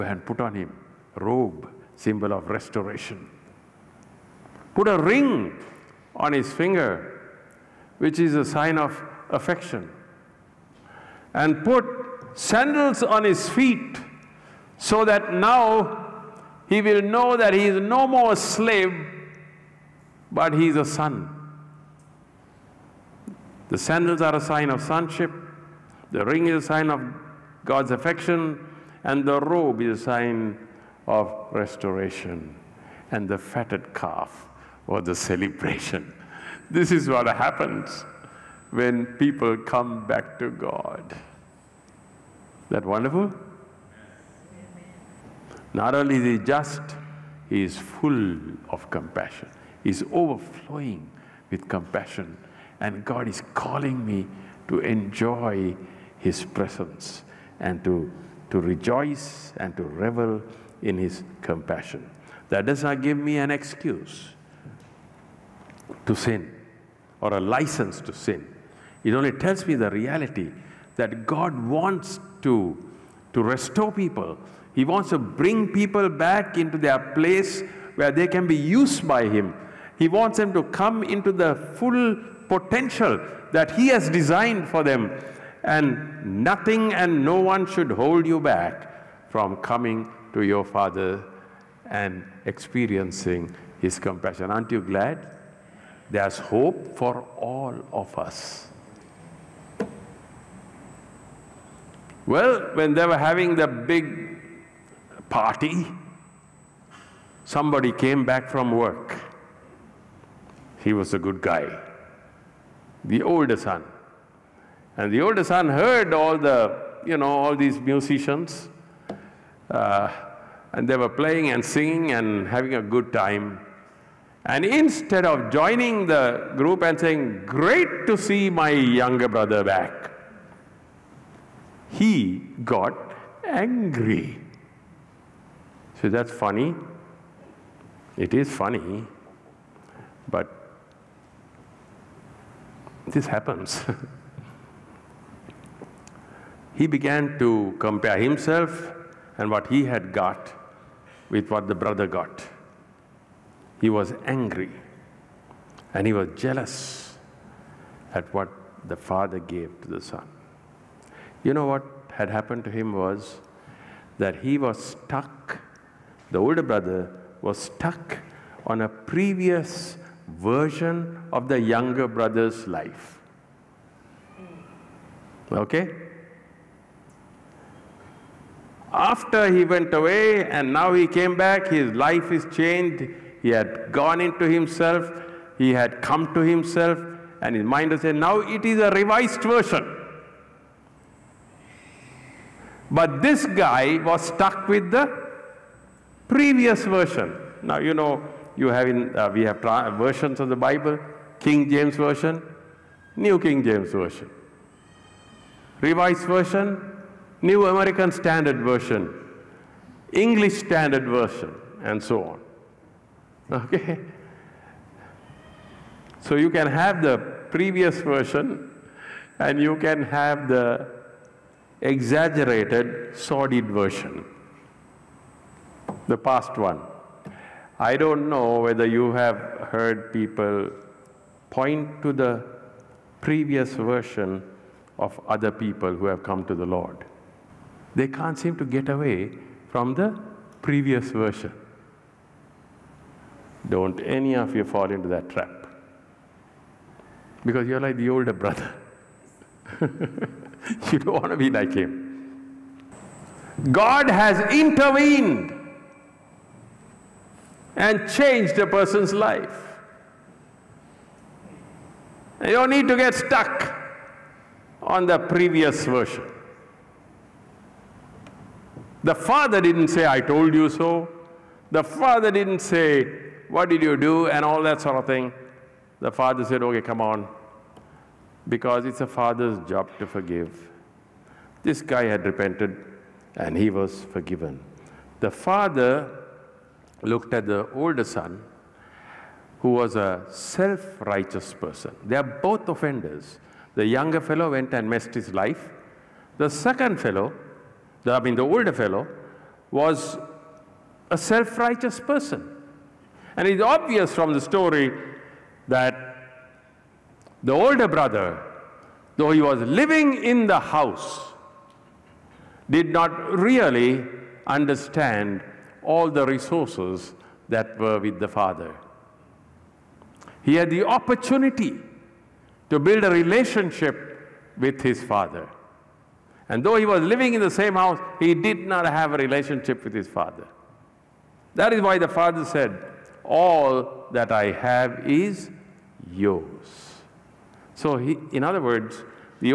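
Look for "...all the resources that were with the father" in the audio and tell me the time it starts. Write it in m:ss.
5:15.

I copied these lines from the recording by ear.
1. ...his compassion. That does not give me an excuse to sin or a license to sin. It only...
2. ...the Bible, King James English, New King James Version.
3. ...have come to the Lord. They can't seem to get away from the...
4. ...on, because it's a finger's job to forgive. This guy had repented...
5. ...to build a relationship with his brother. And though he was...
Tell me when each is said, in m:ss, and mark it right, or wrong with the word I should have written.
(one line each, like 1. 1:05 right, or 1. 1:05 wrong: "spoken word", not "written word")
1. 1:00 right
2. 3:20 wrong: "Version", not "English"
3. 3:56 right
4. 4:37 wrong: "father", not "finger"
5. 5:22 wrong: "father", not "brother".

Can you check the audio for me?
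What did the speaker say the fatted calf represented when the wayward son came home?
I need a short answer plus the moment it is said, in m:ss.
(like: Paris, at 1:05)
The celebration, at 0:35.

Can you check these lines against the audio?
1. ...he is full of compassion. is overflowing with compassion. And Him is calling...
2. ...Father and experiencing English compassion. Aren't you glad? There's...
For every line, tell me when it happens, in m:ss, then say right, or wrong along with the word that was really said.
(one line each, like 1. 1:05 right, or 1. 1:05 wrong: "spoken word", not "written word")
1. 0:47 wrong: "God", not "Him"
2. 1:30 wrong: "His", not "English".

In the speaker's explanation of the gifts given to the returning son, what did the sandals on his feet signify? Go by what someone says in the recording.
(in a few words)
Sonship.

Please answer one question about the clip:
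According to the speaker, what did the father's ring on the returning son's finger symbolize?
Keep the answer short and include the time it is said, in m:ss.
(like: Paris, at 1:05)
God's affection, at 0:27.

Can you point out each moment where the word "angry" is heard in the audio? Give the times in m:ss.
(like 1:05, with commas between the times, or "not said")
2:13, 2:34.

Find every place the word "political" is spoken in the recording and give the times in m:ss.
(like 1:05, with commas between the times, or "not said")
not said.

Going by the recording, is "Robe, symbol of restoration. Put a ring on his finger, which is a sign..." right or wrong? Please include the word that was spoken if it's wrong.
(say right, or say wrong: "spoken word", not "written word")
right.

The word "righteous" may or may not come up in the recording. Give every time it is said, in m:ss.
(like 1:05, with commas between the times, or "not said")
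4:50, 5:01.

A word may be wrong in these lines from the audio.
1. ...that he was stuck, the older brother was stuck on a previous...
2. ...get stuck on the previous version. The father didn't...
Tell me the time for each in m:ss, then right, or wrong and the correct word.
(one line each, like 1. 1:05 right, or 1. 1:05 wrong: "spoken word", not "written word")
1. 2:44 right
2. 4:22 right.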